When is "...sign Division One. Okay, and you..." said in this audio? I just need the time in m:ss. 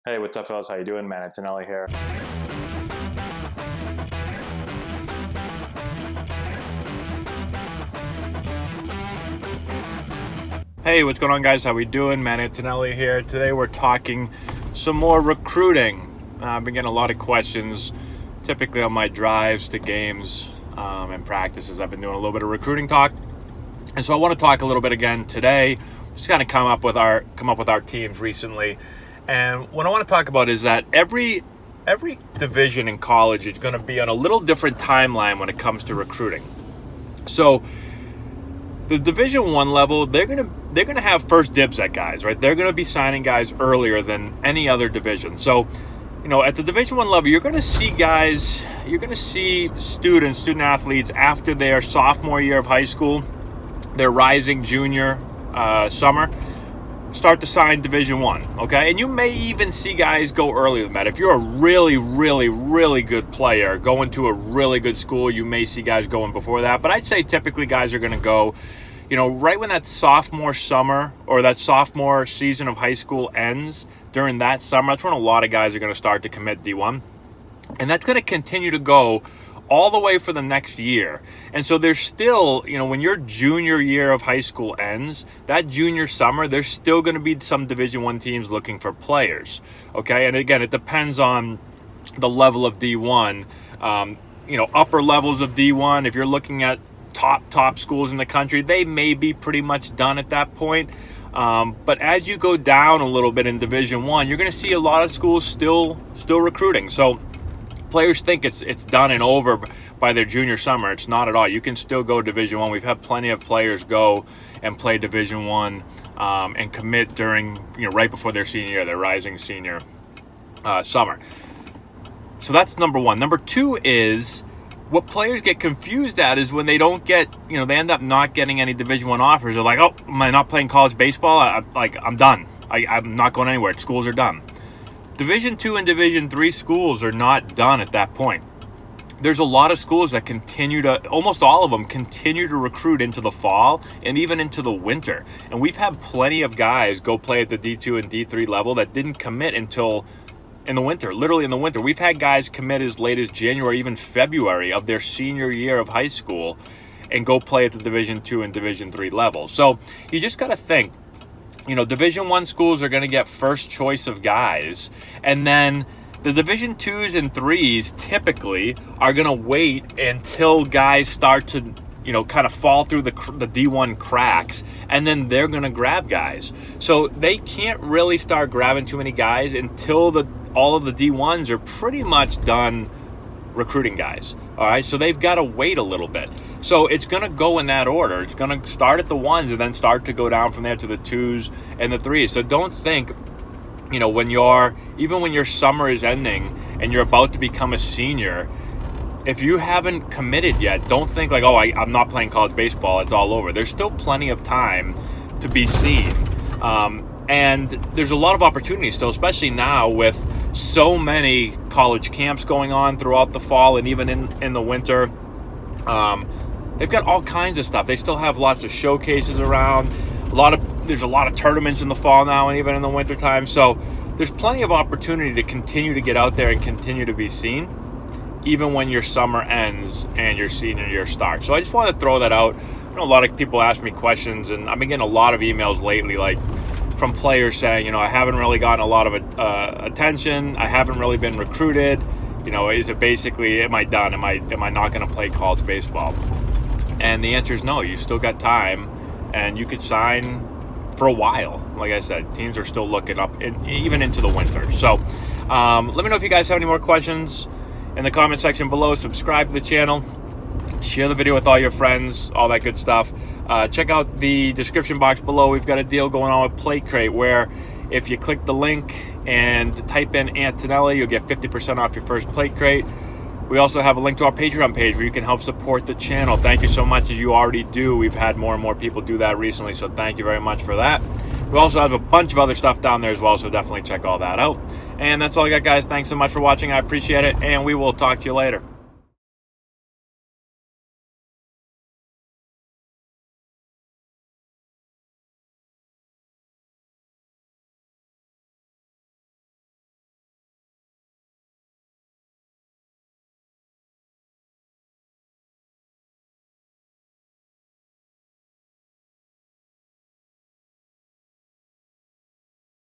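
0:57.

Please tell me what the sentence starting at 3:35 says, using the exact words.
Um, they've got all kinds of stuff.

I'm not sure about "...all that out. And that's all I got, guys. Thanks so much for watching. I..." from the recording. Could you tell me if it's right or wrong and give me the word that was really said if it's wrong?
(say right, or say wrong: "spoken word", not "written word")
right.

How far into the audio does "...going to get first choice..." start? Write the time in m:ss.
2:42.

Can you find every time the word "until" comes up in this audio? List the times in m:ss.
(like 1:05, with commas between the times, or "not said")
2:29, 2:49, 2:59.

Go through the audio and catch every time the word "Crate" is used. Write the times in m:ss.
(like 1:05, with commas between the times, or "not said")
4:26, 4:32.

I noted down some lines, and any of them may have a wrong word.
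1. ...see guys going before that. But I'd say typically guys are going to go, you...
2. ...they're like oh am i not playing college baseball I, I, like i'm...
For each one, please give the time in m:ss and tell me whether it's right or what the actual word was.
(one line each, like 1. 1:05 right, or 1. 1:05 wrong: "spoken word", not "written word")
1. 1:05 right
2. 2:09 right.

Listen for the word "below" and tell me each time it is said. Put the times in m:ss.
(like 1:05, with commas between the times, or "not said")
4:18, 4:25.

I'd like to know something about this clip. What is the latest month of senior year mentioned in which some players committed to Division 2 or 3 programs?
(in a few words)
February.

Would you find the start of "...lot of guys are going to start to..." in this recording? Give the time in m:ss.
1:15.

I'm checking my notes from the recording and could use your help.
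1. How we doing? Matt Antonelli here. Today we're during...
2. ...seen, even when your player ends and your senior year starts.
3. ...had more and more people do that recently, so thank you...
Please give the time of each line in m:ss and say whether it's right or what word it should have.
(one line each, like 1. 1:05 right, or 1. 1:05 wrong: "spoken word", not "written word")
1. 0:11 wrong: "talking", not "during"
2. 3:47 wrong: "summer", not "player"
3. 4:38 right.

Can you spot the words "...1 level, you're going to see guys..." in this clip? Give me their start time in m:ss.
0:46.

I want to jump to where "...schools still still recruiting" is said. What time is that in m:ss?
1:45.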